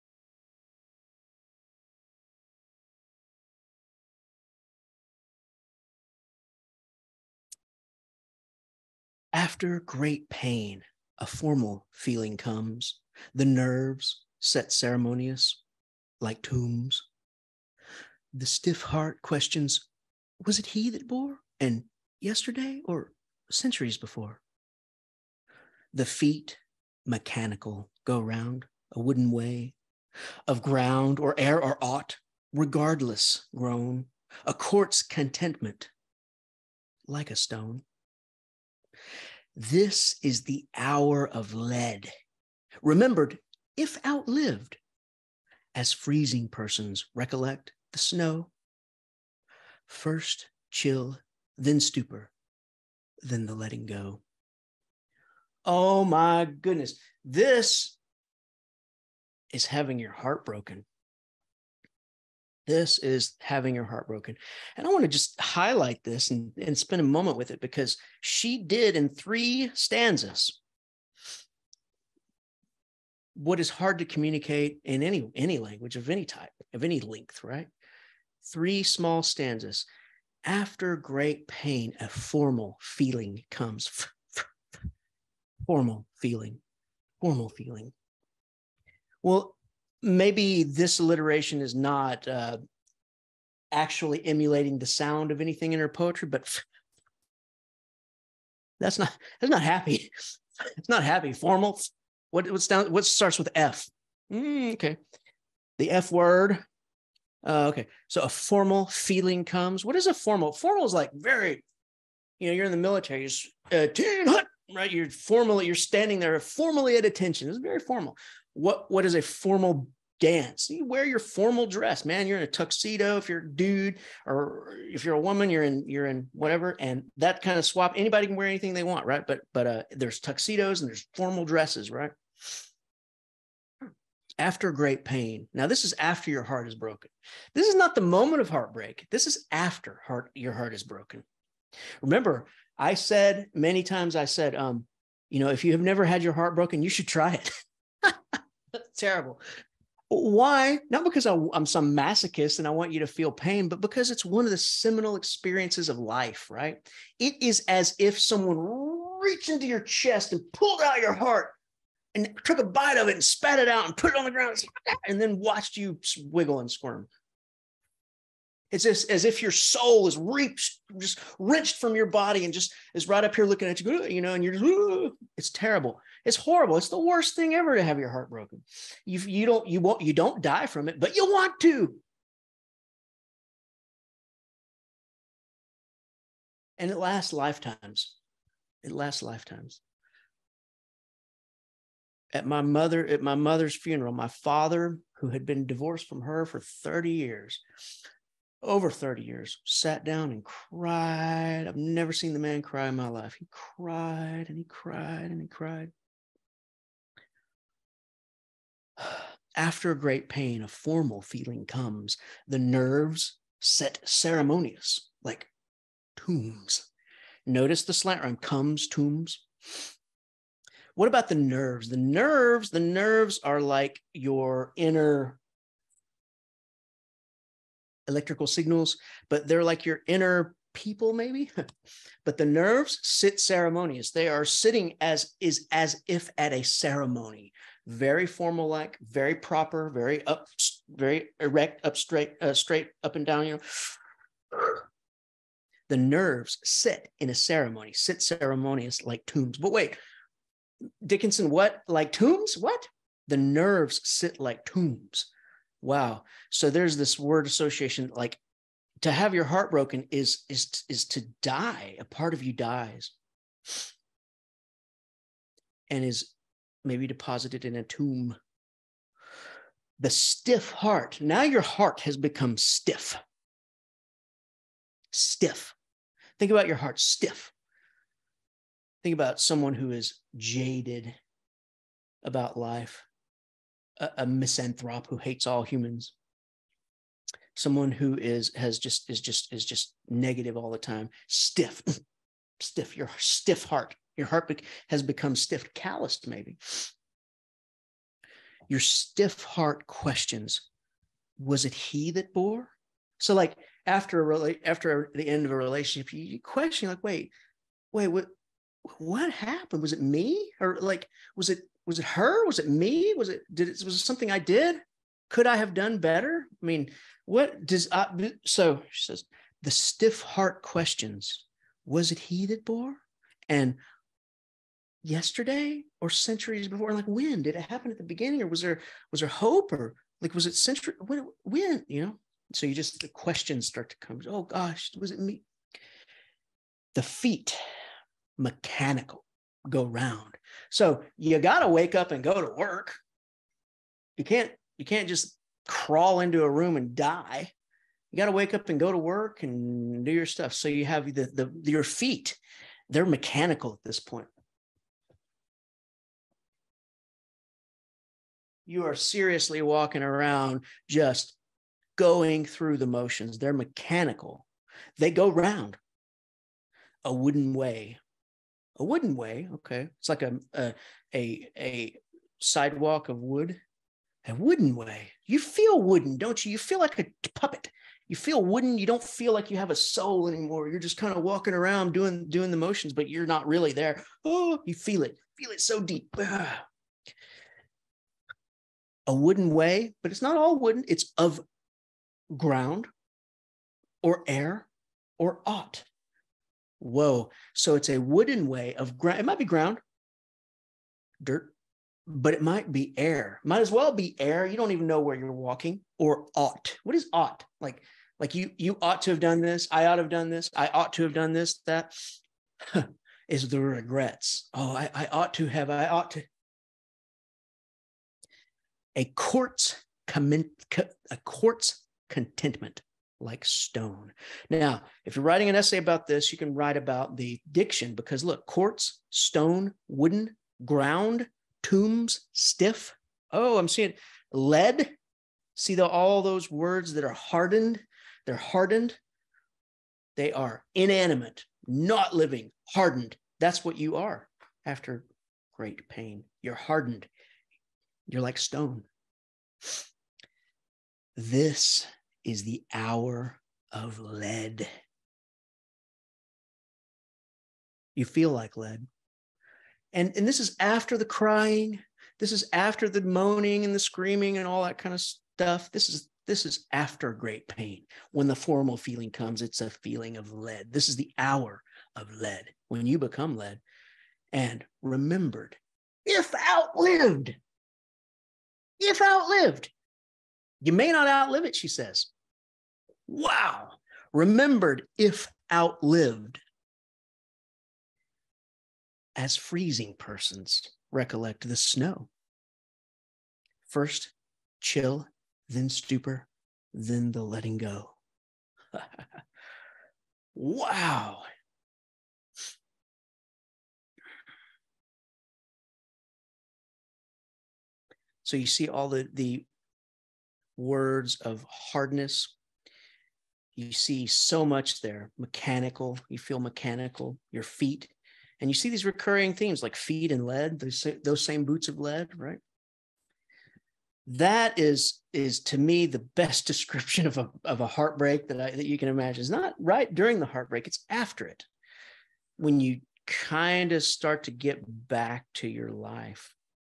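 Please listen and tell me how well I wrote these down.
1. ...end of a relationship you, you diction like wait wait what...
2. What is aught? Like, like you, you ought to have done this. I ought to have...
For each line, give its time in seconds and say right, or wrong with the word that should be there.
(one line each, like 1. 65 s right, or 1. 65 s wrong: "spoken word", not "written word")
1. 305 s wrong: "question", not "diction"
2. 406 s wrong: "ought", not "aught".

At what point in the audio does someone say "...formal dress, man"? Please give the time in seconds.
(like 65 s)
121 s.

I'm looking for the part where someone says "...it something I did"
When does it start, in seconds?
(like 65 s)
313 s.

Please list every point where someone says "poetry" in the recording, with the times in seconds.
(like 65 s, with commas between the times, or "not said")
95 s.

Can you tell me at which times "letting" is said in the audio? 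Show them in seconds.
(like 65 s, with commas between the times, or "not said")
53 s, 497 s.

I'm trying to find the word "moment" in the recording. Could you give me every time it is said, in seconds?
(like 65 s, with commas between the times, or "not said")
67 s, 138 s.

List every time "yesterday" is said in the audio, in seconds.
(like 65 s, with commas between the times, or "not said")
22 s, 325 s.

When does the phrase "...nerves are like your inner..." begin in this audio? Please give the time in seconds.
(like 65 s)
222 s.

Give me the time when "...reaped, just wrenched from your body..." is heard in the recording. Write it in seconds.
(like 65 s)
170 s.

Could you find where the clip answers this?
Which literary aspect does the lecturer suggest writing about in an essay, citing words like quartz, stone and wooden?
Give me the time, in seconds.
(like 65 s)
427 s.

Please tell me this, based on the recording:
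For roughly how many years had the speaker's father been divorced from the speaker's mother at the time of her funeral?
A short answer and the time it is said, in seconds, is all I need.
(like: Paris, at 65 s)
Over 30, at 198 s.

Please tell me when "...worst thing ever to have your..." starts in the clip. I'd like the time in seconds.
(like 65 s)
176 s.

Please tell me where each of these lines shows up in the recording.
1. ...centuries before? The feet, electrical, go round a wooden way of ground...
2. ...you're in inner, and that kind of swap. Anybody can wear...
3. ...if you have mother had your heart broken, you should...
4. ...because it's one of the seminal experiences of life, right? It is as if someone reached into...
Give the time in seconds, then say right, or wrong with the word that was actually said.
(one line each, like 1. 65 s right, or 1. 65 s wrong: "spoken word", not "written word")
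1. 23 s wrong: "mechanical", not "electrical"
2. 125 s wrong: "whatever", not "inner"
3. 145 s wrong: "never", not "mother"
4. 153 s right.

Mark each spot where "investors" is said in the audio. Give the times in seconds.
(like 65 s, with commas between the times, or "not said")
not said.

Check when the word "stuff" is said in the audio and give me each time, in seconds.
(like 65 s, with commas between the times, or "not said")
350 s, 465 s.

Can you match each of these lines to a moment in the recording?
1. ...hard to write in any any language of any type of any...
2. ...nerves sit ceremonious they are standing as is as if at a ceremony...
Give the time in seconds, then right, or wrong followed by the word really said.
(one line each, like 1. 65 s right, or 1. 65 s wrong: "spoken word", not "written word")
1. 73 s wrong: "communicate", not "write"
2. 232 s wrong: "sitting", not "standing".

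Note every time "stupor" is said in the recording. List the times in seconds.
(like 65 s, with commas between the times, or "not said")
51 s, 495 s.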